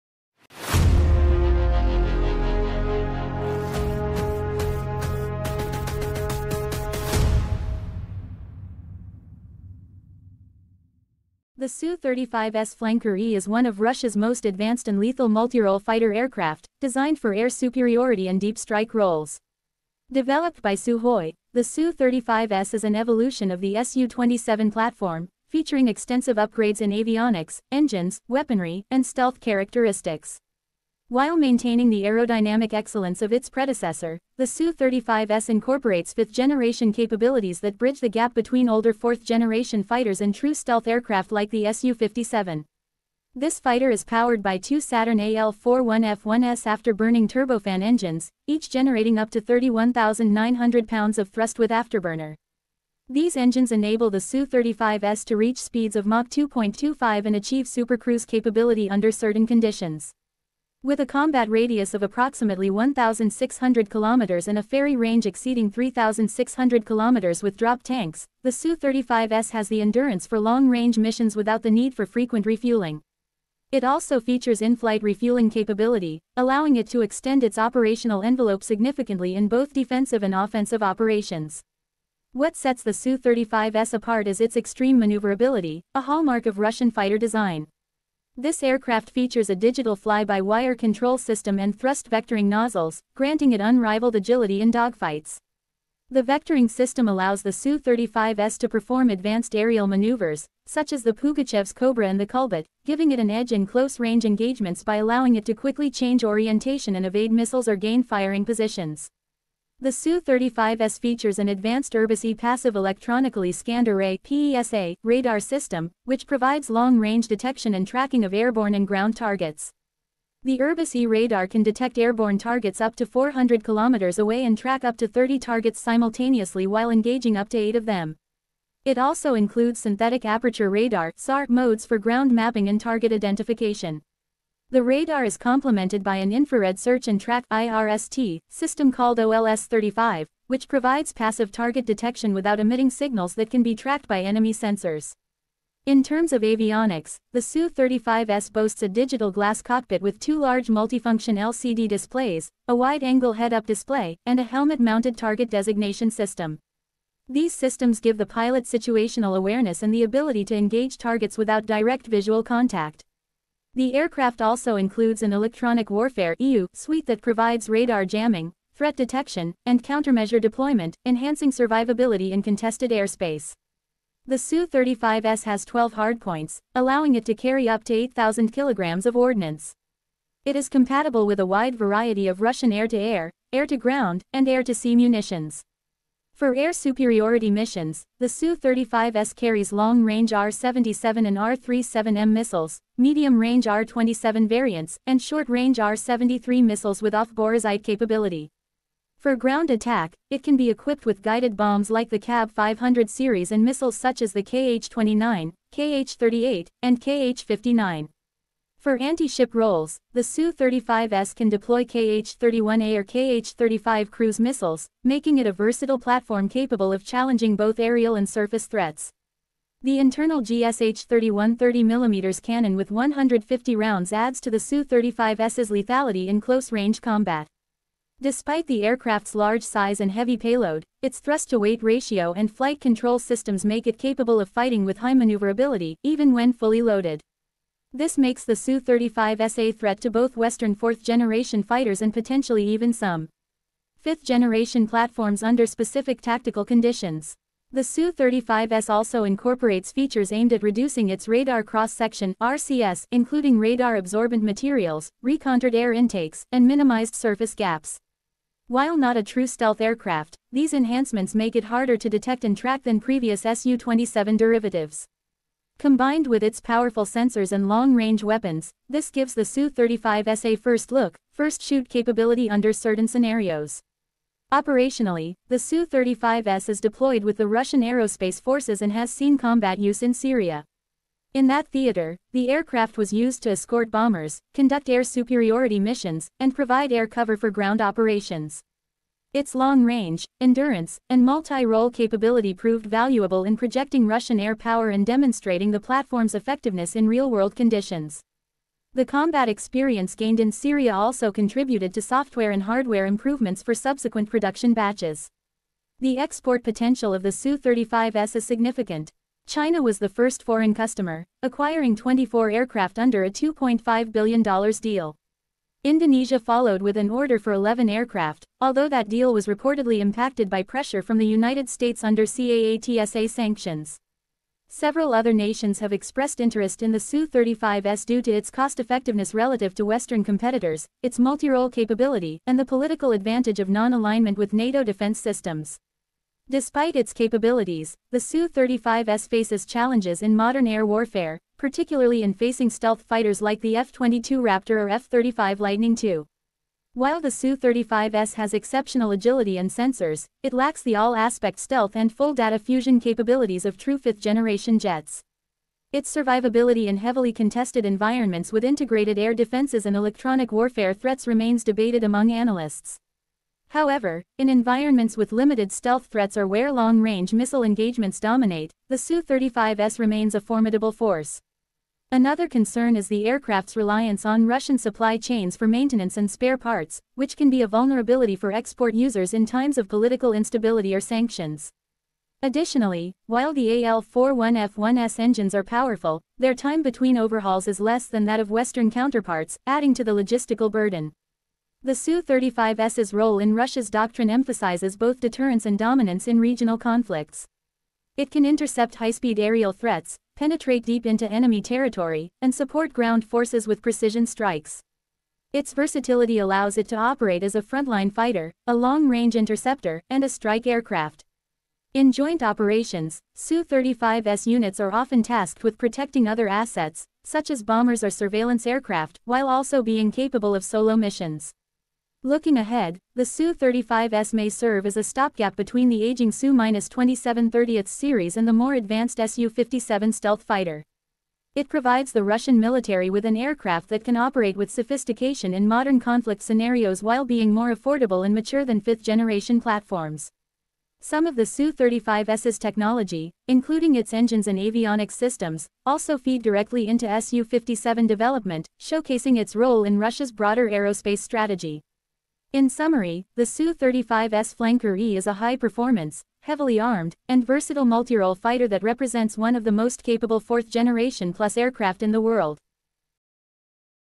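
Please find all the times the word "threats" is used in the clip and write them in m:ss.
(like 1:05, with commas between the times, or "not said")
2:48, 3:38, 3:59, 6:00, 6:06, 6:39.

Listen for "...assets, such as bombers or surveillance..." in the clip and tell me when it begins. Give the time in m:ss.
6:56.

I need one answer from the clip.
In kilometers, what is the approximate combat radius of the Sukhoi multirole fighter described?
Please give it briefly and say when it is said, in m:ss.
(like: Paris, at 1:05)
1,600 kilometers, at 1:02.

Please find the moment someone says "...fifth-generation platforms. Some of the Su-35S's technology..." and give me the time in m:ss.
7:18.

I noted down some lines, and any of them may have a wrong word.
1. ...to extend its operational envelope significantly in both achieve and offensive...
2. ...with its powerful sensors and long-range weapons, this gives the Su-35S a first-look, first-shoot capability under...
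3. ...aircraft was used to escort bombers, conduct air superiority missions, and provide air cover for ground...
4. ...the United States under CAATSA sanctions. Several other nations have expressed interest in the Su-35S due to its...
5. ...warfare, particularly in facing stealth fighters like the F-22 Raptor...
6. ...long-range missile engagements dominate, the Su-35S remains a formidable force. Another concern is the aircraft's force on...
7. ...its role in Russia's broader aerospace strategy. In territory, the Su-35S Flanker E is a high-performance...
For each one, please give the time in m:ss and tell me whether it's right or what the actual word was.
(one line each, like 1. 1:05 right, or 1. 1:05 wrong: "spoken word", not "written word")
1. 1:16 wrong: "defensive", not "achieve"
2. 4:26 right
3. 4:42 right
4. 5:21 right
5. 5:40 right
6. 6:06 wrong: "reliance", not "force"
7. 7:29 wrong: "summary", not "territory".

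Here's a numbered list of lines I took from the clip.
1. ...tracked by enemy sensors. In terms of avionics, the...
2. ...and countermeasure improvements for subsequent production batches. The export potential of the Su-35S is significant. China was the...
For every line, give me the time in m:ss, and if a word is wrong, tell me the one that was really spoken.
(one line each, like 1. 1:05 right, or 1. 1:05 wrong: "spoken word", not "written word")
1. 2:23 right
2. 5:02 wrong: "hardware", not "countermeasure".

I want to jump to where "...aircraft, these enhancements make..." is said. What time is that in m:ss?
4:19.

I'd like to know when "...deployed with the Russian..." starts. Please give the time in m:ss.
4:36.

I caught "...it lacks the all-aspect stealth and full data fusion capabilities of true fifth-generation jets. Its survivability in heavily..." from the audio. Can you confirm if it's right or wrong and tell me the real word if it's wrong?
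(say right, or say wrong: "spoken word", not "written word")
right.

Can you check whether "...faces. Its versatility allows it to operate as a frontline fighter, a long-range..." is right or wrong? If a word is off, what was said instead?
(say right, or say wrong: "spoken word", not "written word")
wrong: "strikes", not "faces".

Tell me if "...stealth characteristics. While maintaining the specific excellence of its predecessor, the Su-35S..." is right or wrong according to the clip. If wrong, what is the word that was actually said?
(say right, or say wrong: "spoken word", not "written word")
wrong: "aerodynamic", not "specific".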